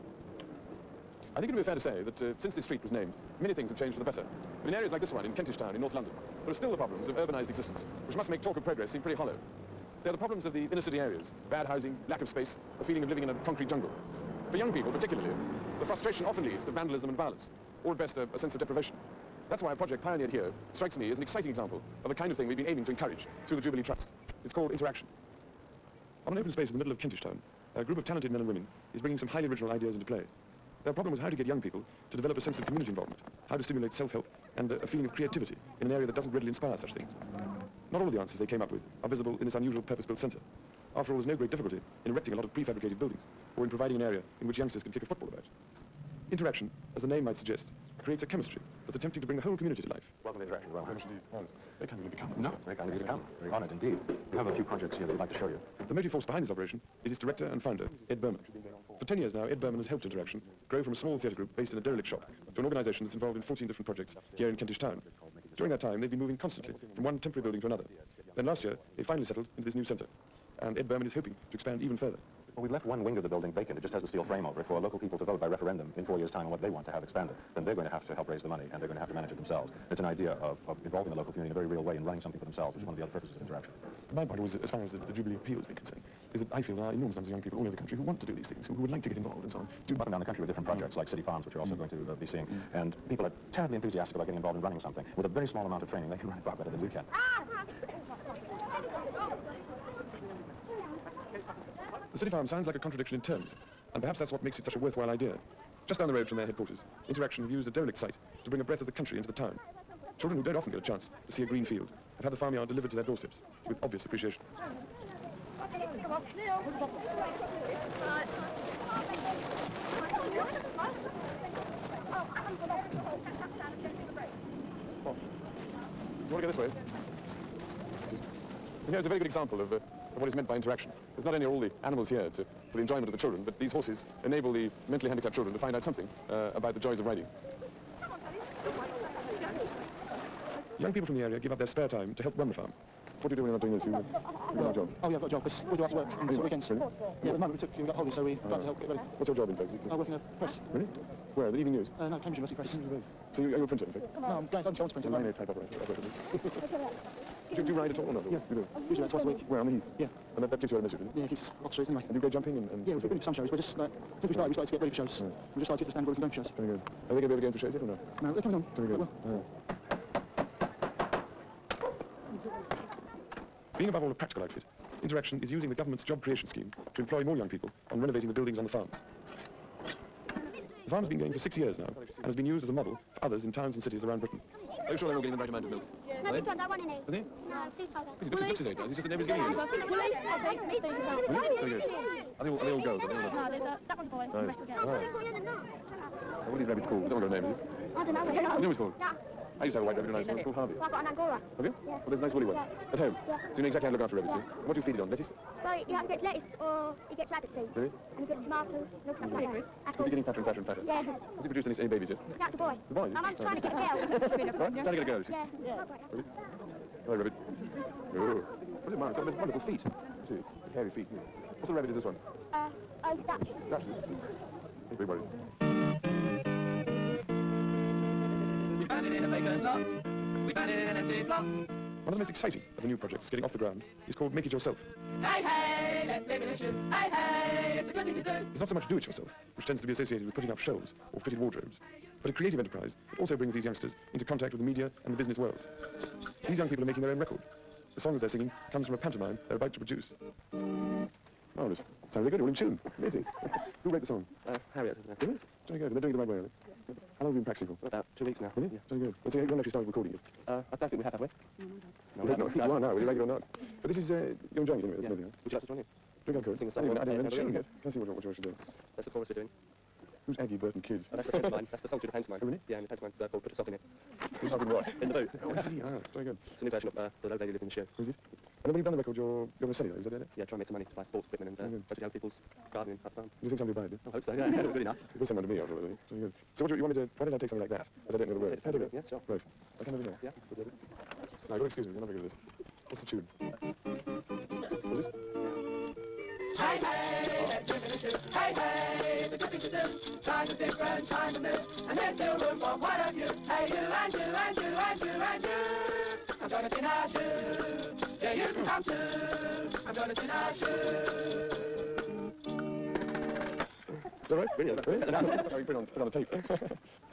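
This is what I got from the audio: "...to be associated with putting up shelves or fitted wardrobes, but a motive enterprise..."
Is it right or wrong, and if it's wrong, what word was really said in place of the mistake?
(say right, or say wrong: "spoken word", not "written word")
wrong: "creative", not "motive".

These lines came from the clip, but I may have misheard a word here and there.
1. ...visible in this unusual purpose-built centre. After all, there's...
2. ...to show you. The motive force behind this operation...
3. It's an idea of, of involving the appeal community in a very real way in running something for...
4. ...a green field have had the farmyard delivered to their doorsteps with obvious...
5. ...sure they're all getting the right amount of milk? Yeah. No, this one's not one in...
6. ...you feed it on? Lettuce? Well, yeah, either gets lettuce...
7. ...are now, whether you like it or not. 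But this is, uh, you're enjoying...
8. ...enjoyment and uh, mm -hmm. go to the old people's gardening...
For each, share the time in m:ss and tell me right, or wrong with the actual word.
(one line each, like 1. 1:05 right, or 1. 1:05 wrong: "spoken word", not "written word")
1. 0:39 right
2. 0:55 right
3. 1:19 wrong: "local", not "appeal"
4. 1:51 right
5. 3:04 right
6. 3:24 right
7. 4:22 right
8. 4:41 wrong: "equipment", not "enjoyment".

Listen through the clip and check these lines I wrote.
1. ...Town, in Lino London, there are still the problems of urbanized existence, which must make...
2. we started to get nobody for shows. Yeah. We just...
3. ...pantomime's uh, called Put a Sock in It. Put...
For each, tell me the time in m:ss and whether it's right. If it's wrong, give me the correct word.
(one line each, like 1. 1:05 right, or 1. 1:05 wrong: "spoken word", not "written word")
1. 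0:05 wrong: "North", not "Lino"
2. 2:44 wrong: "ready", not "nobody"
3. 4:32 right.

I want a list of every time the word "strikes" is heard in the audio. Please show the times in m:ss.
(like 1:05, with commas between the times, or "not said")
0:20.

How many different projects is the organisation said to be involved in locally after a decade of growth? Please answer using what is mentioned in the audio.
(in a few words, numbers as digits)
14.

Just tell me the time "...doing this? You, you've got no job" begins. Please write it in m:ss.
2:23.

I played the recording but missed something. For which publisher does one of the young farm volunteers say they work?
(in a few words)
Cambridge University Press.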